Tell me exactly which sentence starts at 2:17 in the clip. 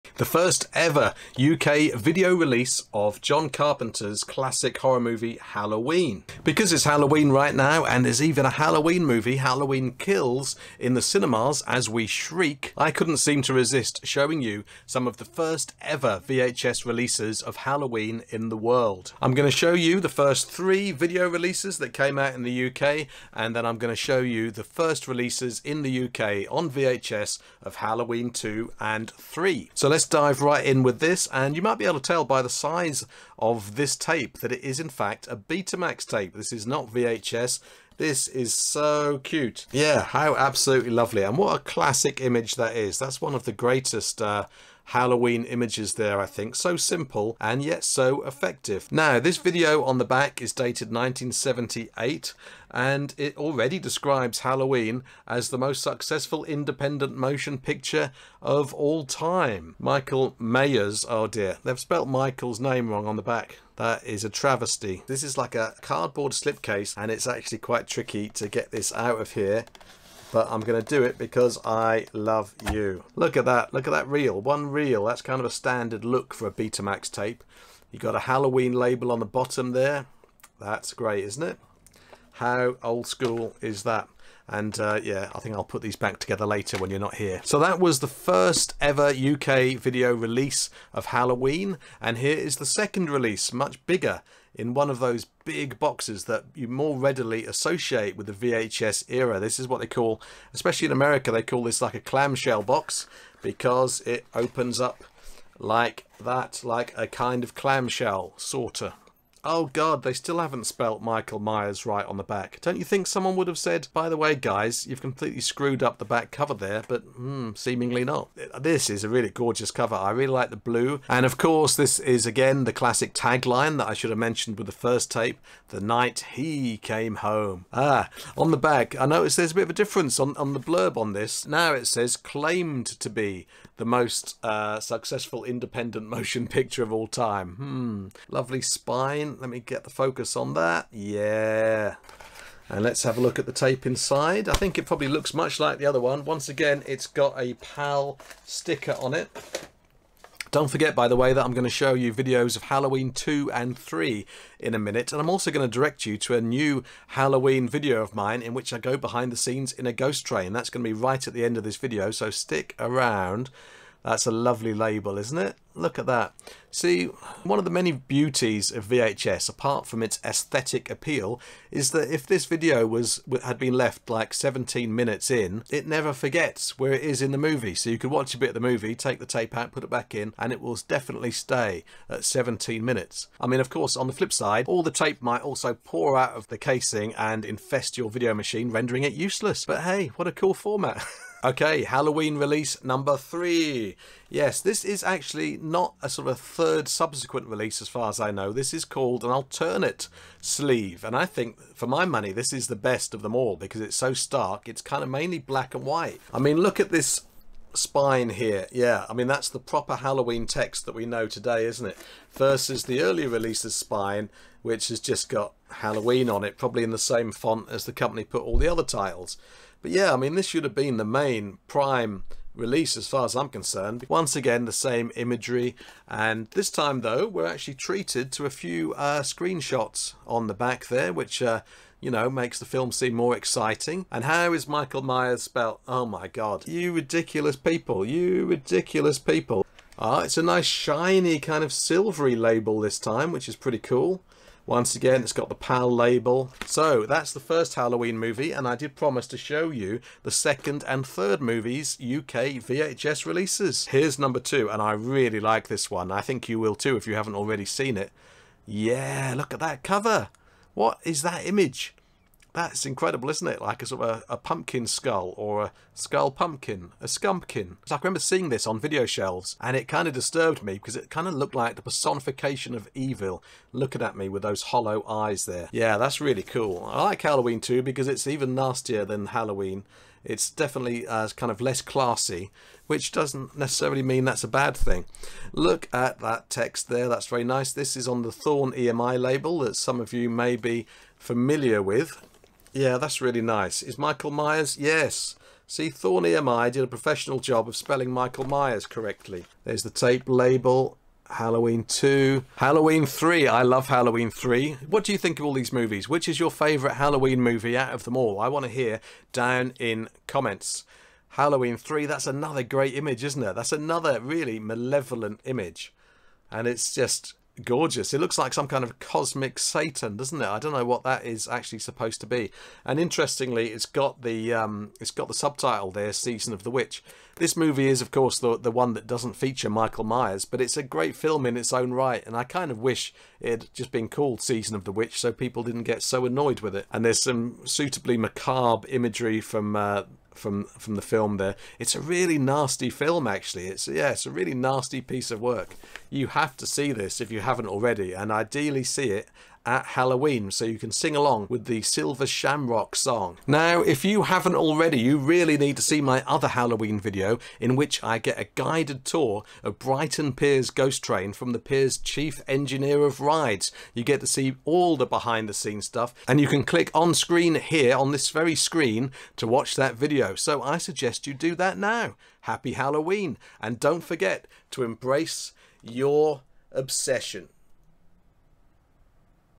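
Hmm, lovely spine let me get the focus on that.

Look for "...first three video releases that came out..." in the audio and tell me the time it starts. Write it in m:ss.
0:20.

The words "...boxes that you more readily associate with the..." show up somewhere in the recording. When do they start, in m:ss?
1:35.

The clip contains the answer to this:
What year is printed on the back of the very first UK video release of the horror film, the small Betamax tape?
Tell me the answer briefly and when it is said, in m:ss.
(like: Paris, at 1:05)
1978, at 0:50.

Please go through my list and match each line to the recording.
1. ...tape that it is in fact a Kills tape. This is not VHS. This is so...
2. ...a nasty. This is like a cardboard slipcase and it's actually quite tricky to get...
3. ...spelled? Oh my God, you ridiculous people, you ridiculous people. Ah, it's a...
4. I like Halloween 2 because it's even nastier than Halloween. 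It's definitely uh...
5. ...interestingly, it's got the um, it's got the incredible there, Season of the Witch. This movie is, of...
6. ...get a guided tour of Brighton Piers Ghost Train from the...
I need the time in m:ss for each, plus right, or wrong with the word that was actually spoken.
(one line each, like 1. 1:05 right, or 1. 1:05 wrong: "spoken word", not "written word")
1. 0:33 wrong: "Betamax", not "Kills"
2. 1:04 wrong: "travesty", not "nasty"
3. 3:55 right
4. 4:36 right
5. 5:22 wrong: "subtitle", not "incredible"
6. 5:58 right.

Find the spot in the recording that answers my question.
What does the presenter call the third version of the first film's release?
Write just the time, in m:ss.
3:19.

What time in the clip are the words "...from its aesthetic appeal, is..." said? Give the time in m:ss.
2:49.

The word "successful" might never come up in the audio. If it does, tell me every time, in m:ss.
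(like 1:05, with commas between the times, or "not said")
0:55, 2:14.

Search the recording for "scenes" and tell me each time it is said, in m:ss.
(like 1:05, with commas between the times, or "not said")
2:39, 6:05.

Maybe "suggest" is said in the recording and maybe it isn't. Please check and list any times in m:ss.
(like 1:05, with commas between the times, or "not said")
6:10.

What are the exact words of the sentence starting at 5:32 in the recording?
And I kind of wish it had just been called Season of the Witch, so people didn't get so annoyed with it.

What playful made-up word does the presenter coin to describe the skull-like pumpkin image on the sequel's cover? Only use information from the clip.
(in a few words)
Scumpkin.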